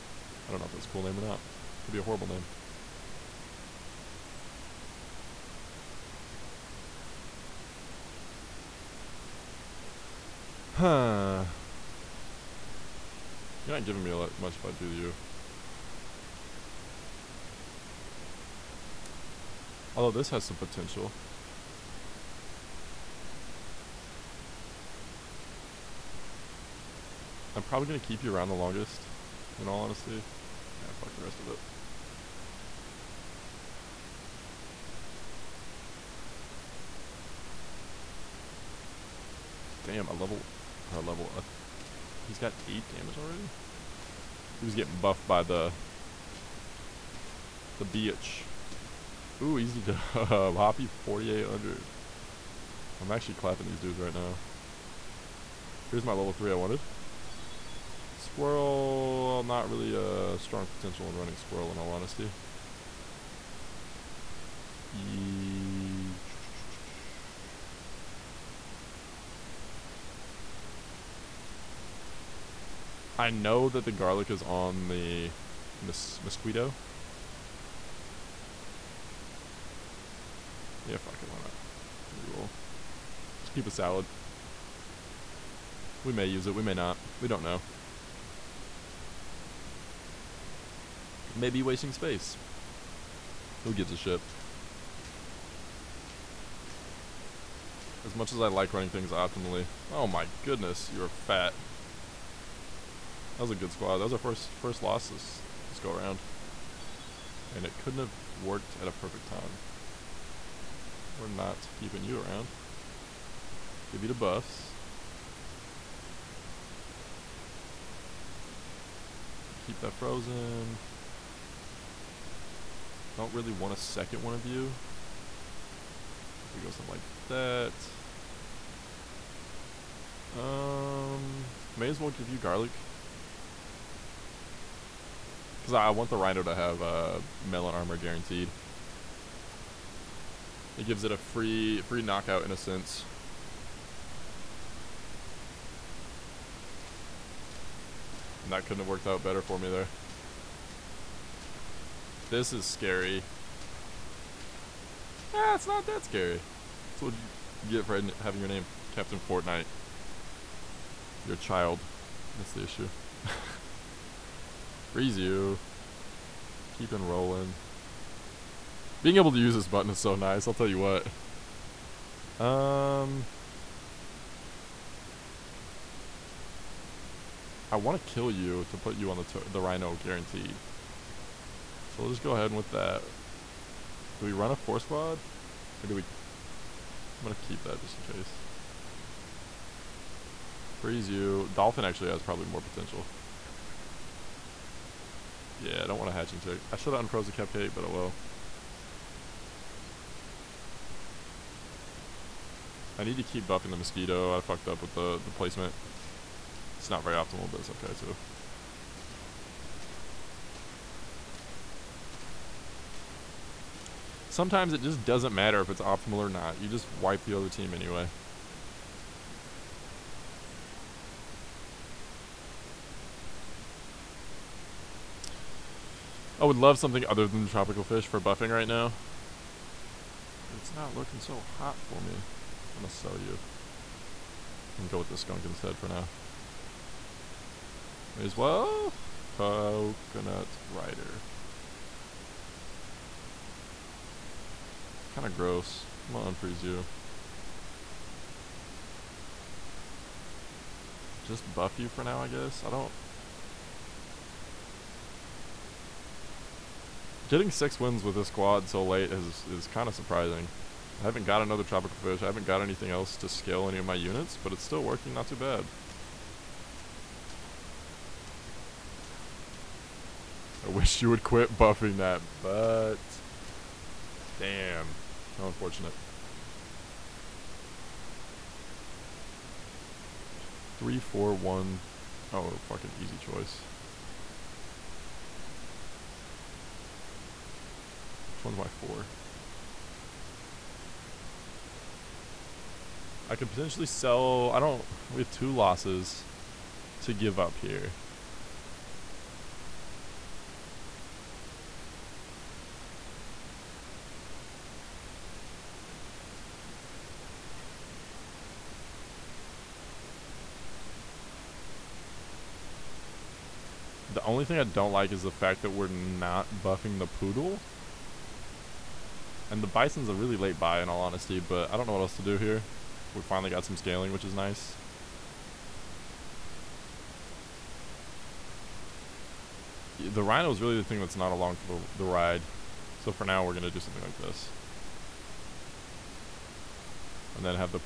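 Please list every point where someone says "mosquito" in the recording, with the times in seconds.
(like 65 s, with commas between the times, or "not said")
76 s, 203 s.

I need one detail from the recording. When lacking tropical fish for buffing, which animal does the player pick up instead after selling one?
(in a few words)
Skunk.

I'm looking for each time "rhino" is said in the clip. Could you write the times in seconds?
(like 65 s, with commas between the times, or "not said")
136 s, 179 s, 330 s.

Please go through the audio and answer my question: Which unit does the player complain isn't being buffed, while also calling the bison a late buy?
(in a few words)
Poodle.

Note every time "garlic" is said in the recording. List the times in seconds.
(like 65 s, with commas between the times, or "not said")
73 s, 132 s.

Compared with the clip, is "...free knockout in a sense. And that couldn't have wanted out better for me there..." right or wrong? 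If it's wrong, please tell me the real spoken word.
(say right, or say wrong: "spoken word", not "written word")
wrong: "worked", not "wanted".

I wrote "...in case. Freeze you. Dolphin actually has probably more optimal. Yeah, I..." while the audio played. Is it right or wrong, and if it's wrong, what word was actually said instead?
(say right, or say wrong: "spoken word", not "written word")
wrong: "potential", not "optimal".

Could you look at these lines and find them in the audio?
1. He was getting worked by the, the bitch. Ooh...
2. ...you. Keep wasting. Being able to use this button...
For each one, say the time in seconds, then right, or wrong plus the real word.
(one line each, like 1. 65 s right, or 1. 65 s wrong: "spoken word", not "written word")
1. 44 s wrong: "buffed", not "worked"
2. 165 s wrong: "enrolling", not "wasting".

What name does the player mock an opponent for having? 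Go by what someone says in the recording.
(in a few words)
Captain Fortnite.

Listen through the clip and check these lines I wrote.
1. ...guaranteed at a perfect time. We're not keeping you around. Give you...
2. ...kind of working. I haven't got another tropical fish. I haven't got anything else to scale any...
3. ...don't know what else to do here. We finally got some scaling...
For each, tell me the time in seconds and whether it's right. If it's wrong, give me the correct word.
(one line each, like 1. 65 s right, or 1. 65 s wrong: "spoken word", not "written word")
1. 108 s wrong: "worked", not "guaranteed"
2. 259 s wrong: "surprising", not "working"
3. 321 s right.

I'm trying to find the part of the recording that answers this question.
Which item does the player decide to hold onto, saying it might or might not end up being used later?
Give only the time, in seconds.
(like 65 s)
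83 s.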